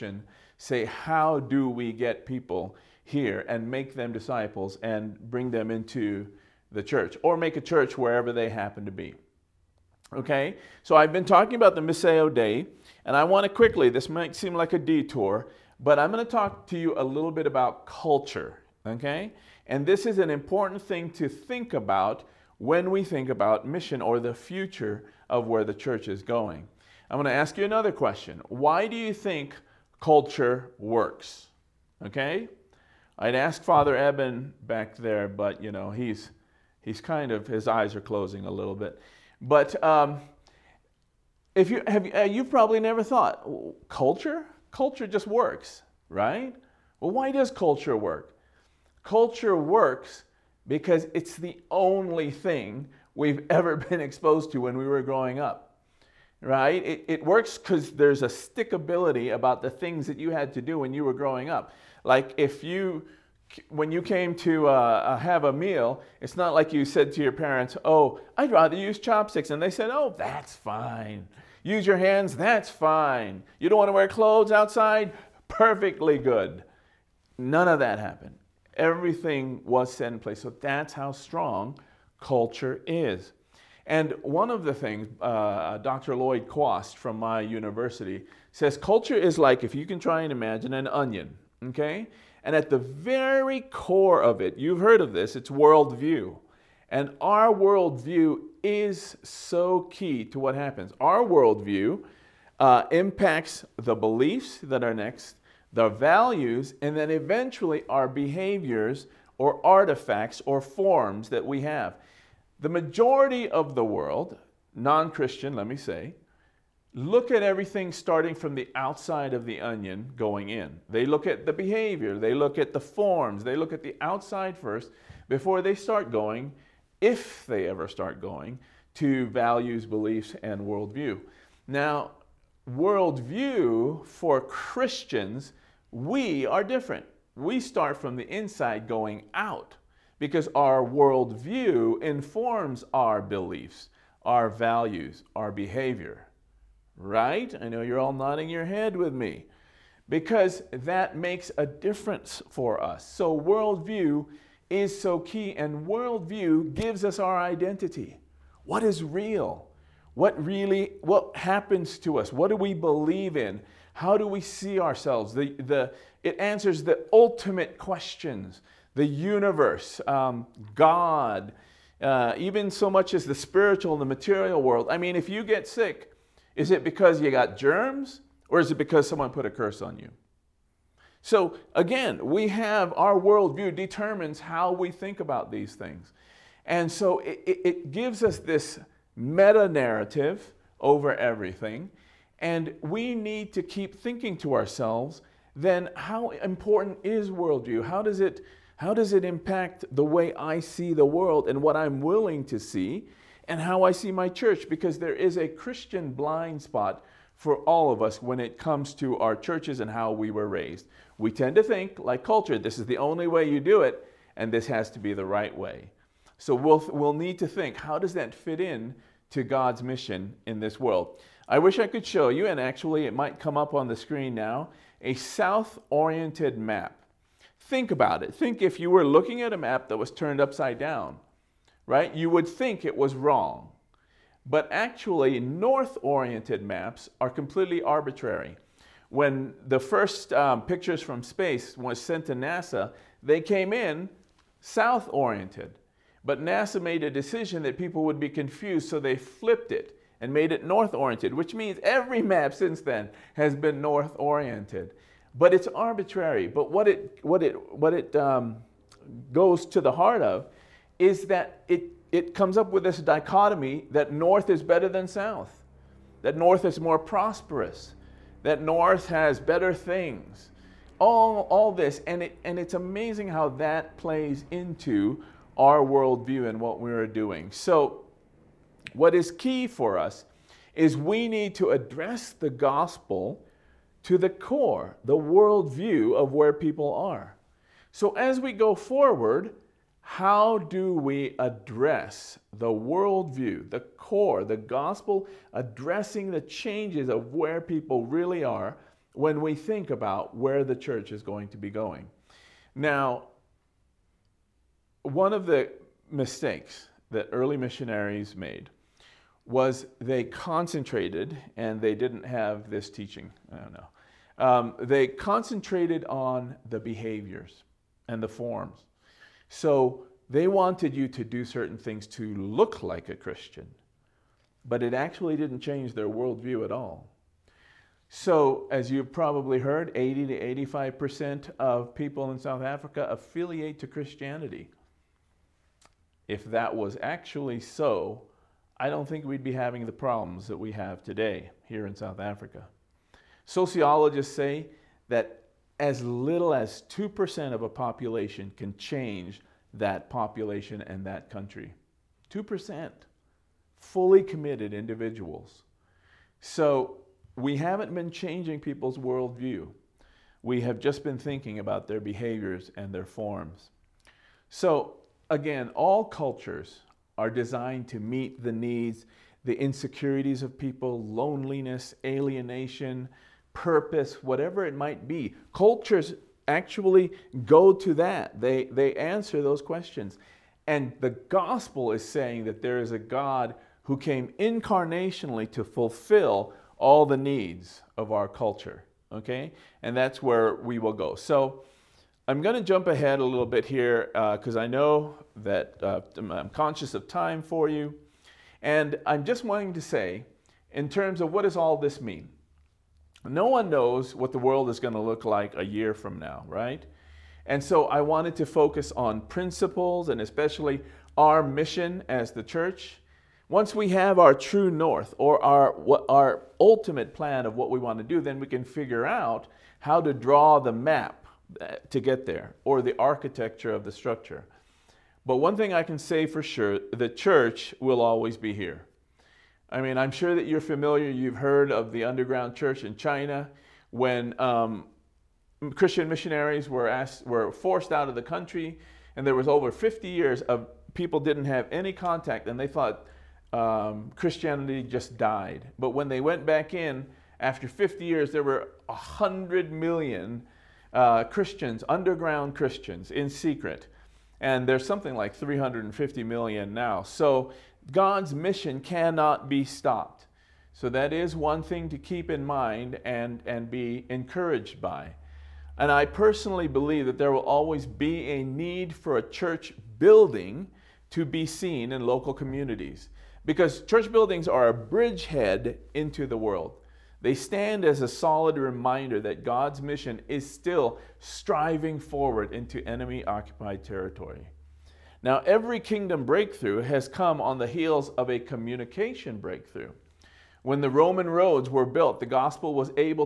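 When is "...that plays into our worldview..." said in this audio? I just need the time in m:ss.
4:33.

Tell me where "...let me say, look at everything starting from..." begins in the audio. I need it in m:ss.
1:55.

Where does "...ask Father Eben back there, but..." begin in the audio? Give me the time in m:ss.
0:33.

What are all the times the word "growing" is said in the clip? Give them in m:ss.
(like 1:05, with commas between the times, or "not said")
0:55, 1:01.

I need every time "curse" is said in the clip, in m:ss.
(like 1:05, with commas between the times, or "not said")
2:59.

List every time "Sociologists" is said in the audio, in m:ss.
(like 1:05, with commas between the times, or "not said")
5:43.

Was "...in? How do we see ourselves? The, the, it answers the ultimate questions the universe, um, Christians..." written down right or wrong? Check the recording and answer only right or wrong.
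wrong.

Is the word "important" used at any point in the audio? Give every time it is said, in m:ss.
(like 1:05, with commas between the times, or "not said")
0:20, 3:16.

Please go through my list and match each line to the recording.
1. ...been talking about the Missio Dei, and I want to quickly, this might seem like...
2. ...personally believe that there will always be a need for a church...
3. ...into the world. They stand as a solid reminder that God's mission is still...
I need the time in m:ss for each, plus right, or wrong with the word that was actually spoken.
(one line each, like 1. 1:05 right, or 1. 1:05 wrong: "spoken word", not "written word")
1. 0:11 right
2. 7:46 right
3. 7:55 right.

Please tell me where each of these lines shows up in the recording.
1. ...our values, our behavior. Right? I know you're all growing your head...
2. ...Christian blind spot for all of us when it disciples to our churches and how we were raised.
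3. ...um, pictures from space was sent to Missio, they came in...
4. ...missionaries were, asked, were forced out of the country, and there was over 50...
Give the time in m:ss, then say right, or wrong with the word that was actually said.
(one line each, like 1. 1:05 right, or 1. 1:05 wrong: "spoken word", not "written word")
1. 2:24 wrong: "nodding", not "growing"
2. 3:25 wrong: "comes", not "disciples"
3. 4:00 wrong: "NASA", not "Missio"
4. 7:16 right.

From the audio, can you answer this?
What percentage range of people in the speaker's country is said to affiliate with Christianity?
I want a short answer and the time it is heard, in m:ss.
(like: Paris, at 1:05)
80 to 85%, at 5:29.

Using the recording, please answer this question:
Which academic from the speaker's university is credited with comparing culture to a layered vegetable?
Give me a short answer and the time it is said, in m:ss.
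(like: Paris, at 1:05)
Dr. Lloyd Kwast, at 1:25.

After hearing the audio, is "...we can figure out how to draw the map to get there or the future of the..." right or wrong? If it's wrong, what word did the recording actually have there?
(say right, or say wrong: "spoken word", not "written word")
wrong: "architecture", not "future".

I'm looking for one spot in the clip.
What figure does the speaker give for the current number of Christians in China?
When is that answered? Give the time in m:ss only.
7:35.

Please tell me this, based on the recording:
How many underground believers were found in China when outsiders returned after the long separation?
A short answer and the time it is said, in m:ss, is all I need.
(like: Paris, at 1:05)
100 million, at 7:28.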